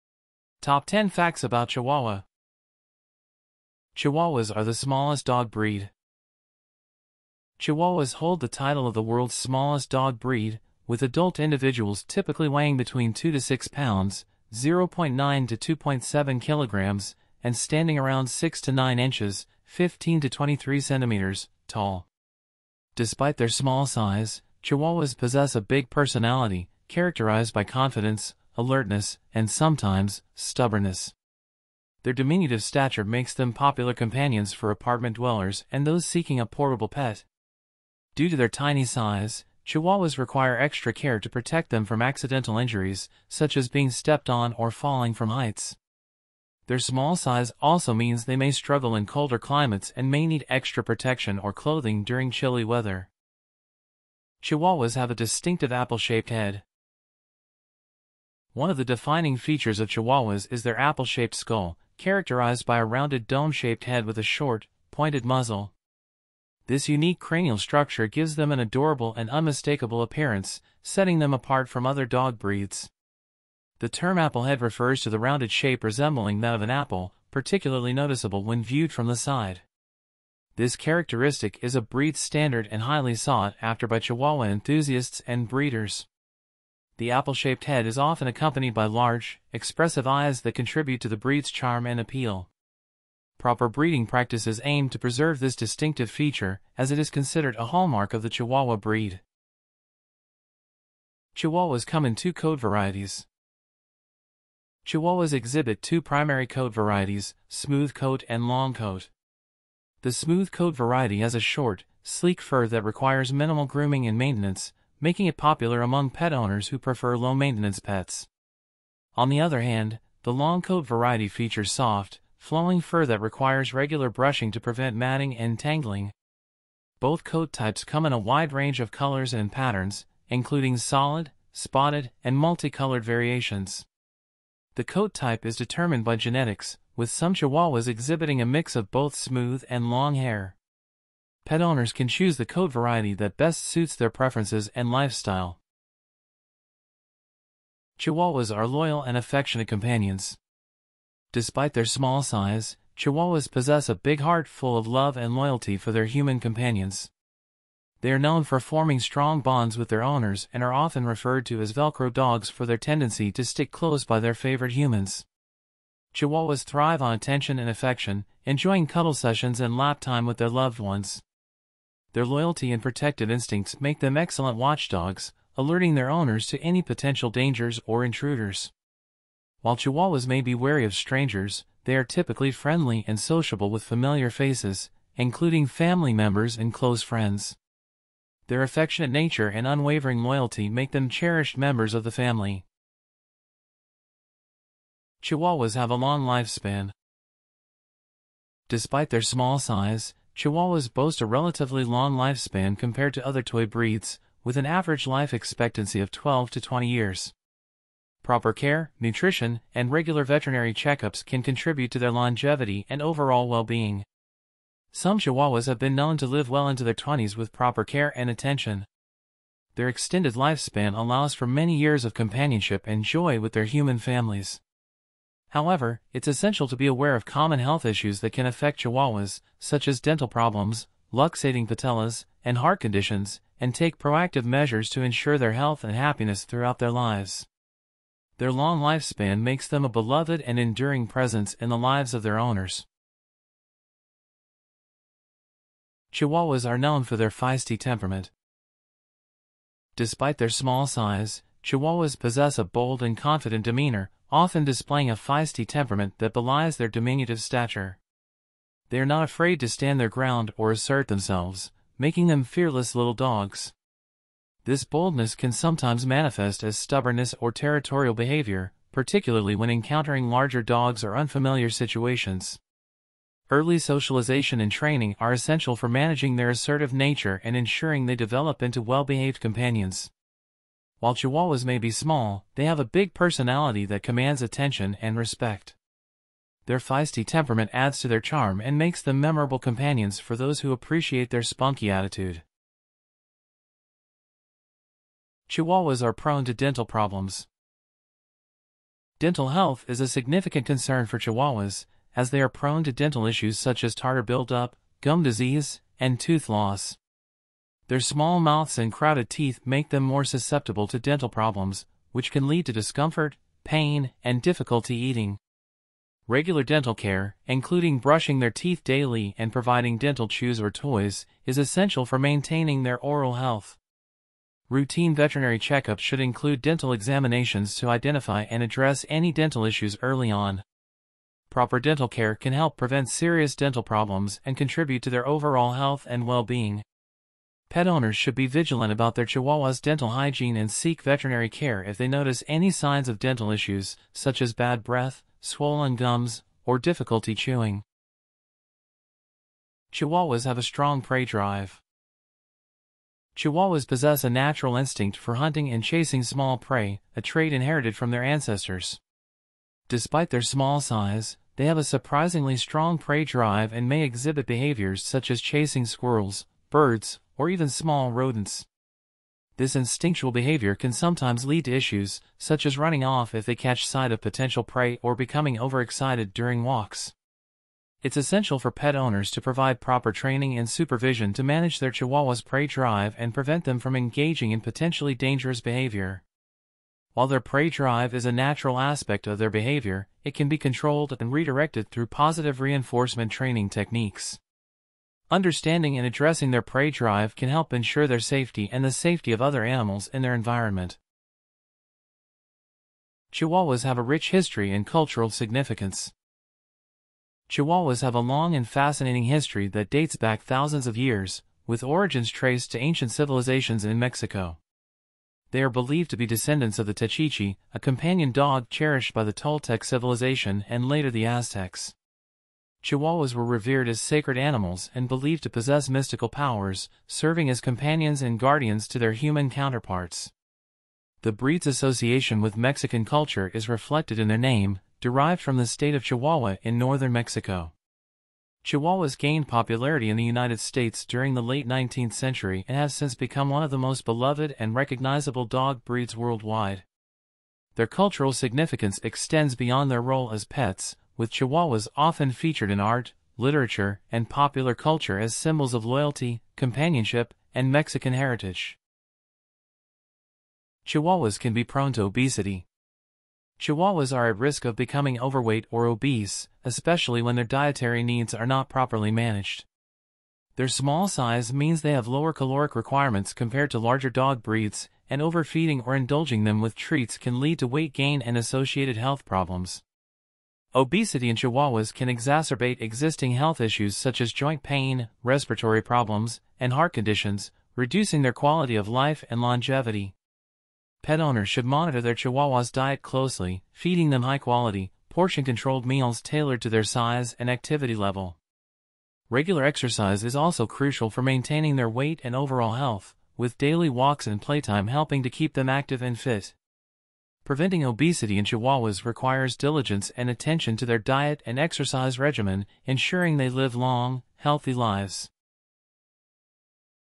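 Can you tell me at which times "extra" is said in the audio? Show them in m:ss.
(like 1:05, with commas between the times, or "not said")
0:40, 0:50.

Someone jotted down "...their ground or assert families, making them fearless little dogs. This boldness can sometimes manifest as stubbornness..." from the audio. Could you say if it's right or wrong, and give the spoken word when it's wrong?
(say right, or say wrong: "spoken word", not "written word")
wrong: "themselves", not "families".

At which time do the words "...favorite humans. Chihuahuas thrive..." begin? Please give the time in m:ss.
2:44.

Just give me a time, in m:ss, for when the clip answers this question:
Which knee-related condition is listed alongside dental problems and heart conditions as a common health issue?
3:51.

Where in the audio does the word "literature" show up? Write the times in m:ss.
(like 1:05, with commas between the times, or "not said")
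7:33.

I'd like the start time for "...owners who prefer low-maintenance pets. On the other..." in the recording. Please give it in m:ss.
1:56.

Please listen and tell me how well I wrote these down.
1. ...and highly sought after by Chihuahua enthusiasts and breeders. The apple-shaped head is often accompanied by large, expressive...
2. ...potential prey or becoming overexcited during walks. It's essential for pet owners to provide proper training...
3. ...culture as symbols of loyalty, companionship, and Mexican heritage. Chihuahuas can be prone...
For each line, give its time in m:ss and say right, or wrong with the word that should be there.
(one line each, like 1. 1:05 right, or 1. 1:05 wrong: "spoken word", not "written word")
1. 1:22 right
2. 6:14 right
3. 7:34 right.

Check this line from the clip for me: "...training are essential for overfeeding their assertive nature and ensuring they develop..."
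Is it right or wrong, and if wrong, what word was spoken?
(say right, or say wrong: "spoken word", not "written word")
wrong: "managing", not "overfeeding".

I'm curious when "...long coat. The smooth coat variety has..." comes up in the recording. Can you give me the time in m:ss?
1:48.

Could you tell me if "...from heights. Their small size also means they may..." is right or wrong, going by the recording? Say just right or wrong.
right.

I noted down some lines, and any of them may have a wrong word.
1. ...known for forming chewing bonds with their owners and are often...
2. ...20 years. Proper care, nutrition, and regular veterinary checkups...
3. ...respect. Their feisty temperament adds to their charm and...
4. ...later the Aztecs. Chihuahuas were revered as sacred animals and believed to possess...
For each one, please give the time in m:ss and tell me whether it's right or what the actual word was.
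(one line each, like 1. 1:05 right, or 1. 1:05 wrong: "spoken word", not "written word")
1. 2:38 wrong: "strong", not "chewing"
2. 3:26 right
3. 4:45 right
4. 7:00 right.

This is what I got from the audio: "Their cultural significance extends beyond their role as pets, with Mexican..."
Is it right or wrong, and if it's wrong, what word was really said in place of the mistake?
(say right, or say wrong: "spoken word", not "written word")
wrong: "Chihuahuas", not "Mexican".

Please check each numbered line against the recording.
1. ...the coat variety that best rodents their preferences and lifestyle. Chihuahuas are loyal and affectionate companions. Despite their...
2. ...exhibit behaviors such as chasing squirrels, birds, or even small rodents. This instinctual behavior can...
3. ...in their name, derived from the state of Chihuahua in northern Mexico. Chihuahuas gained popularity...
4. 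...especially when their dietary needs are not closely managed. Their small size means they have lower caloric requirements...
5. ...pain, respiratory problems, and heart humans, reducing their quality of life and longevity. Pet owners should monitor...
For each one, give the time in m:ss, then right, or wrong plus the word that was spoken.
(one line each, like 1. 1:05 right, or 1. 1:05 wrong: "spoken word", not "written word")
1. 2:22 wrong: "suits", not "rodents"
2. 6:04 right
3. 7:14 right
4. 7:46 wrong: "properly", not "closely"
5. 8:04 wrong: "conditions", not "humans".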